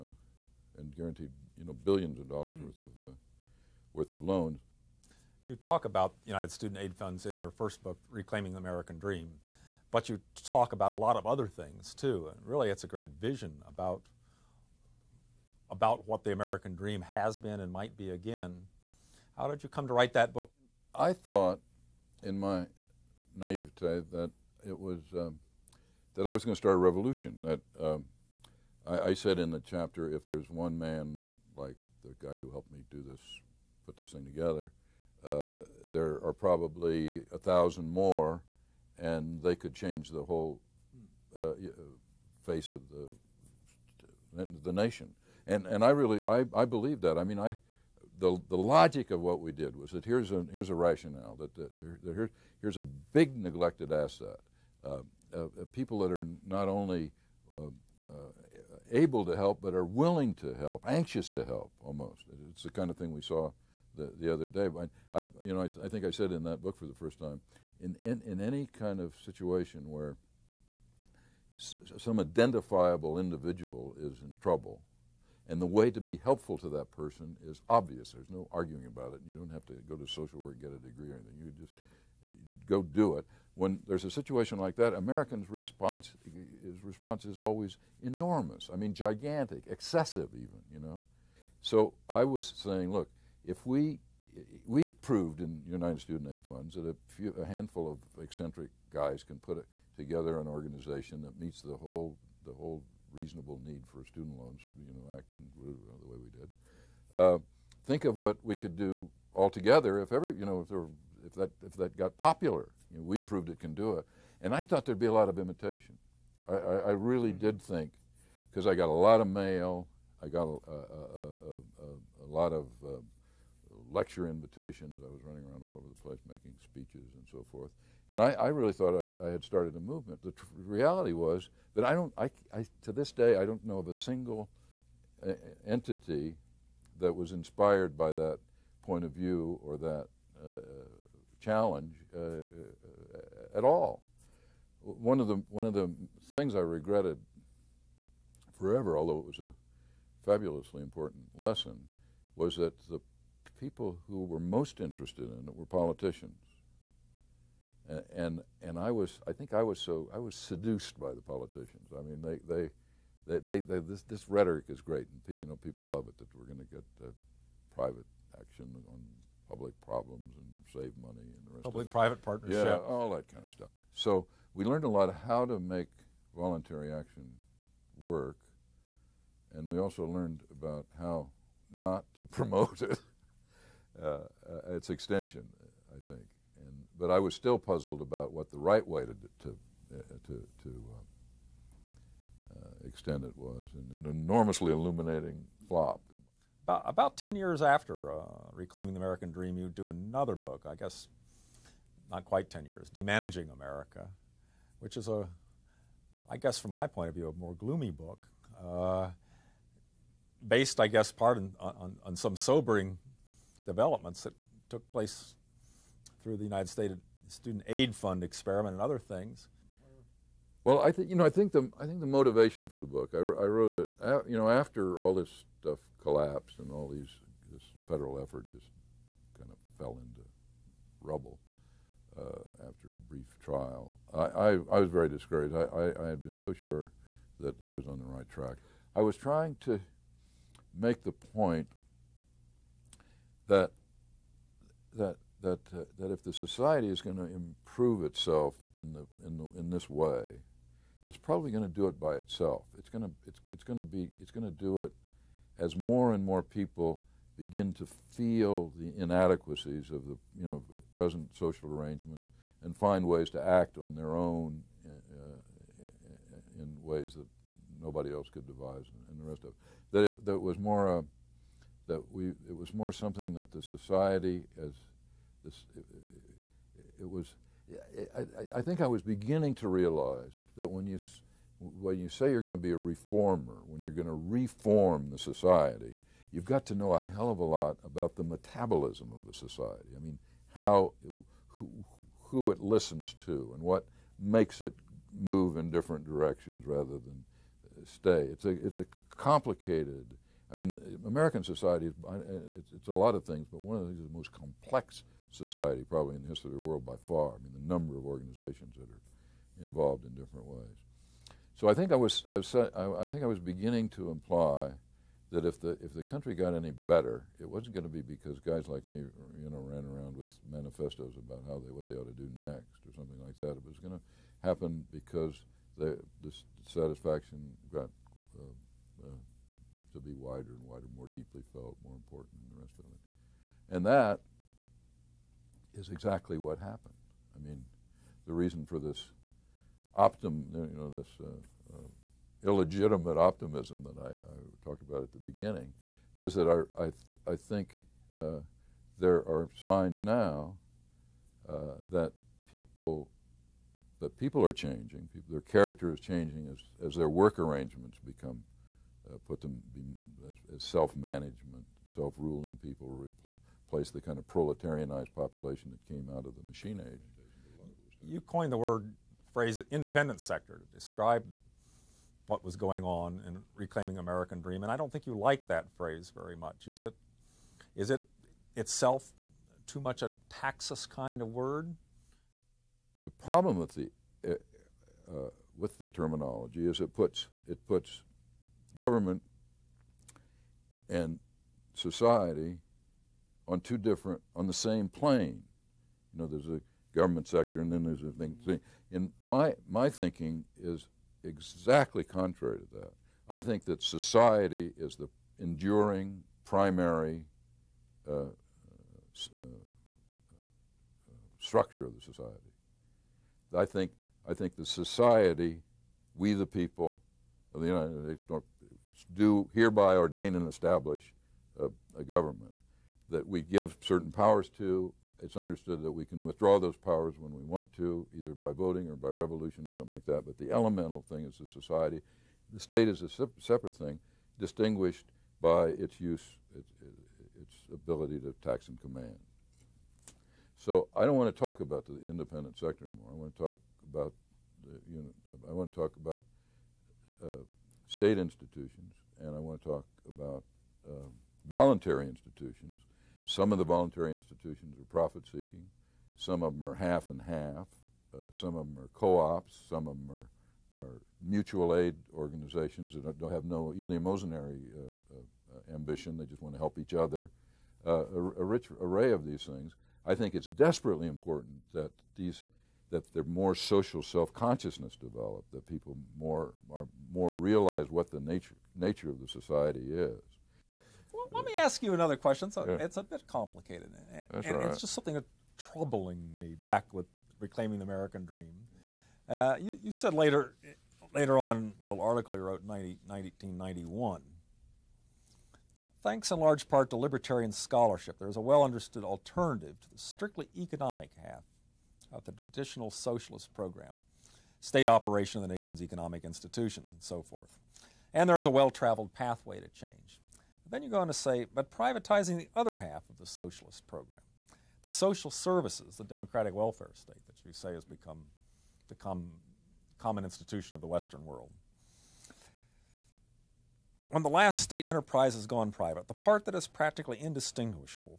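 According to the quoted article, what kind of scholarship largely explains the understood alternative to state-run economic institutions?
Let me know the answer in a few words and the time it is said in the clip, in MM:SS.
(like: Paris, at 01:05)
libertarian, at 08:16.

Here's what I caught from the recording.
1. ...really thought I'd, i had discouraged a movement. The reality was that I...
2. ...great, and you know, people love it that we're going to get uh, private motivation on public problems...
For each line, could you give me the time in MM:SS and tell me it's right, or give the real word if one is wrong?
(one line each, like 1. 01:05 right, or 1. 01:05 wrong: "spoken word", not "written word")
1. 02:08 wrong: "started", not "discouraged"
2. 02:44 wrong: "action", not "motivation".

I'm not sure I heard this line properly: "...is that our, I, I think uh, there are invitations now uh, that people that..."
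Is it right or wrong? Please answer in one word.
wrong.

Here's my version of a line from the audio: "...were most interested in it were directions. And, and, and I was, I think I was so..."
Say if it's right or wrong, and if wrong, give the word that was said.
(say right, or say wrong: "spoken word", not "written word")
wrong: "politicians", not "directions".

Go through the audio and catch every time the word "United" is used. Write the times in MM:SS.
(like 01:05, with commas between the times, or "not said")
00:06, 01:35, 03:36, 06:57.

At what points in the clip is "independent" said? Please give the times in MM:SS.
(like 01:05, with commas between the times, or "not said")
06:09, 07:22.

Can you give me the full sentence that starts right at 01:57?
did think because I got a lot of mail.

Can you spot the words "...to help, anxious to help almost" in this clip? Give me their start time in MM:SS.
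01:00.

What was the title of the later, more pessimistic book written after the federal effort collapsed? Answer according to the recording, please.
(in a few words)
Demanaging America.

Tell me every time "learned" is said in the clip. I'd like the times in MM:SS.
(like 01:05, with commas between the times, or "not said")
02:54, 03:00.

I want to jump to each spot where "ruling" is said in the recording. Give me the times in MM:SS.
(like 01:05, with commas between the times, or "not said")
06:01.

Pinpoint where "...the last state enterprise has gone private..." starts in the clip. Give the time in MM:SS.
08:44.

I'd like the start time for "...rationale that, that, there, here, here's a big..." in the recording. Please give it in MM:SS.
00:50.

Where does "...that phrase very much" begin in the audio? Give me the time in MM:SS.
06:15.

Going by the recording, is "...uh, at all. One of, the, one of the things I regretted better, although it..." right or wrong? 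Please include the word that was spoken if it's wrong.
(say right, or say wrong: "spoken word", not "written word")
wrong: "forever", not "better".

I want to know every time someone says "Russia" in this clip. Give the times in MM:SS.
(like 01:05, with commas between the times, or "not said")
not said.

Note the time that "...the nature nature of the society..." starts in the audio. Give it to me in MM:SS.
07:58.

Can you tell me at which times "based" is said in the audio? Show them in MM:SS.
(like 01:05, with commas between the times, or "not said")
03:30.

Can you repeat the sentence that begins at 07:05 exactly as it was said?
It's understood that we can withdraw those powers when we want to, either by voting or by revolution or something like that.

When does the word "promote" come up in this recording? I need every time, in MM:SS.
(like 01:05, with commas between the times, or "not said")
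03:02.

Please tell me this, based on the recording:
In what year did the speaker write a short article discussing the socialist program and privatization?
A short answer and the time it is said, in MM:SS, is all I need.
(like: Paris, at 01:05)
1991, at 08:13.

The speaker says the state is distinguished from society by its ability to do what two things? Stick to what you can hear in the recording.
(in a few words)
tax and command.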